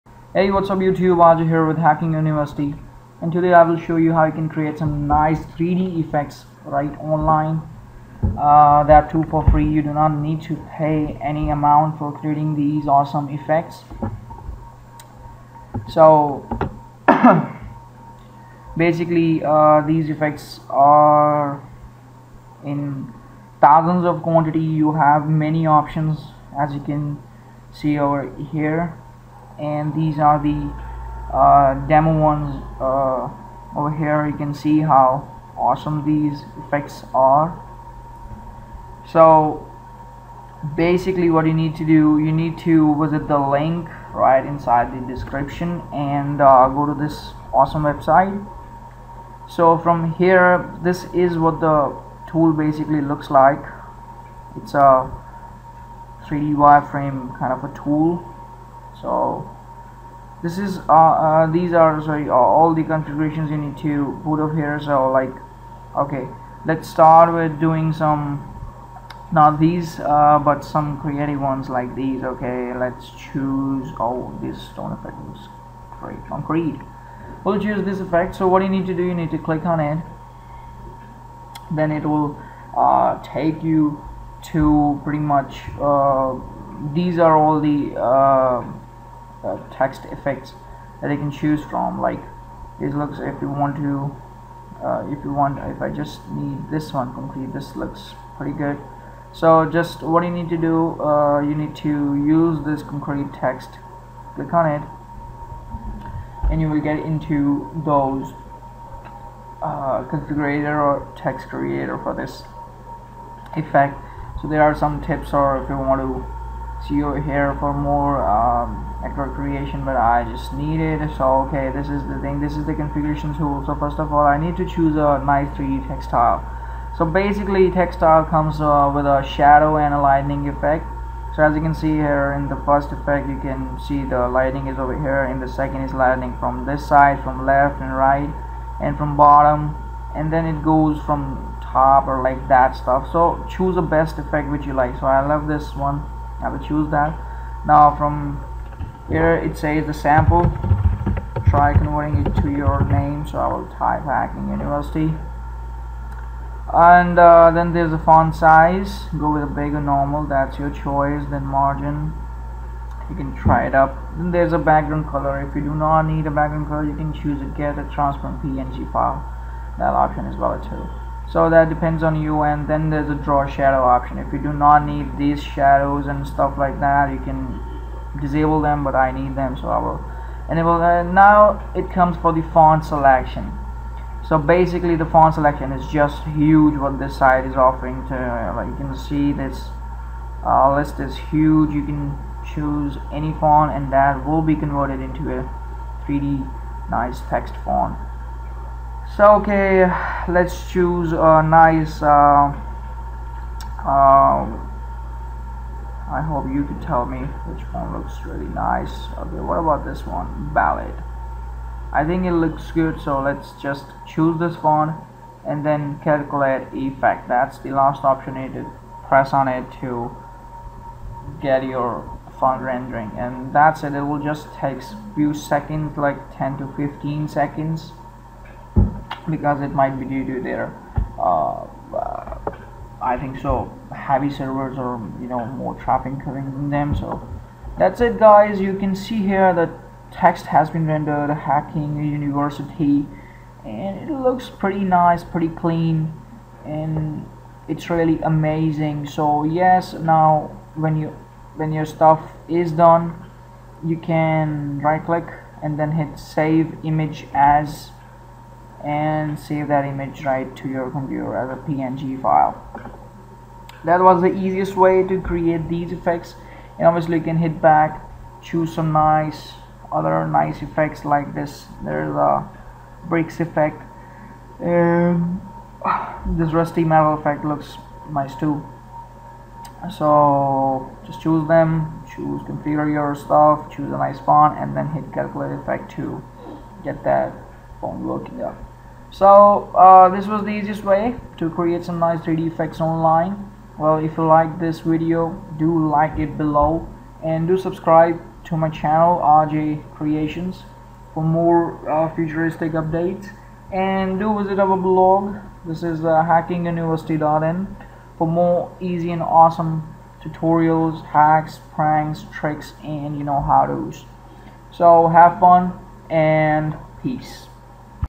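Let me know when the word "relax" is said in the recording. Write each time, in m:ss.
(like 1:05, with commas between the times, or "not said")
not said.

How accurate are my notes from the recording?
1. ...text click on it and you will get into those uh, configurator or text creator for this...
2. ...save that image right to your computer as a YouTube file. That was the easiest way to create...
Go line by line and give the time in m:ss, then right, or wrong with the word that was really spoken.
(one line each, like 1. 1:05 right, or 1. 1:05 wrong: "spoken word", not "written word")
1. 1:43 right
2. 4:19 wrong: "PNG", not "YouTube".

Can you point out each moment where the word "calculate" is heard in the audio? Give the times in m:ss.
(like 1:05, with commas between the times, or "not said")
3:36, 4:45.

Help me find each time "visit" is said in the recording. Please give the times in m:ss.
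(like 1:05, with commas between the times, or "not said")
0:43, 5:04.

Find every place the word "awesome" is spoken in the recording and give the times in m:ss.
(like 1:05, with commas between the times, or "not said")
0:12, 0:35, 0:47, 5:09.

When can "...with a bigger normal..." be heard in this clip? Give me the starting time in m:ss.
2:39.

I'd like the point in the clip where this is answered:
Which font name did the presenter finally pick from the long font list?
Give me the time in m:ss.
3:30.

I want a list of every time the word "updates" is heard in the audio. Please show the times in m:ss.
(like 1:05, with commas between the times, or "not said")
5:02.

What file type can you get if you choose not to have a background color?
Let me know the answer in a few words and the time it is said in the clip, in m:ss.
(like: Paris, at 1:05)
Transparent PNG, at 2:47.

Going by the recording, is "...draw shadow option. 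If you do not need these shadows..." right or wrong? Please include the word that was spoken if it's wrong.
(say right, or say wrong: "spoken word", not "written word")
right.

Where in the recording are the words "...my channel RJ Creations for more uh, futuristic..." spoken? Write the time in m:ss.
4:58.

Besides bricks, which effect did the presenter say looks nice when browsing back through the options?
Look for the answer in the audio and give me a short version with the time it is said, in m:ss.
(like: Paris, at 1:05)
Rusty metal, at 4:36.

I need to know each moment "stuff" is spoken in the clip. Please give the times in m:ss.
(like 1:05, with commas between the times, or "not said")
2:22, 2:56, 4:11, 4:43.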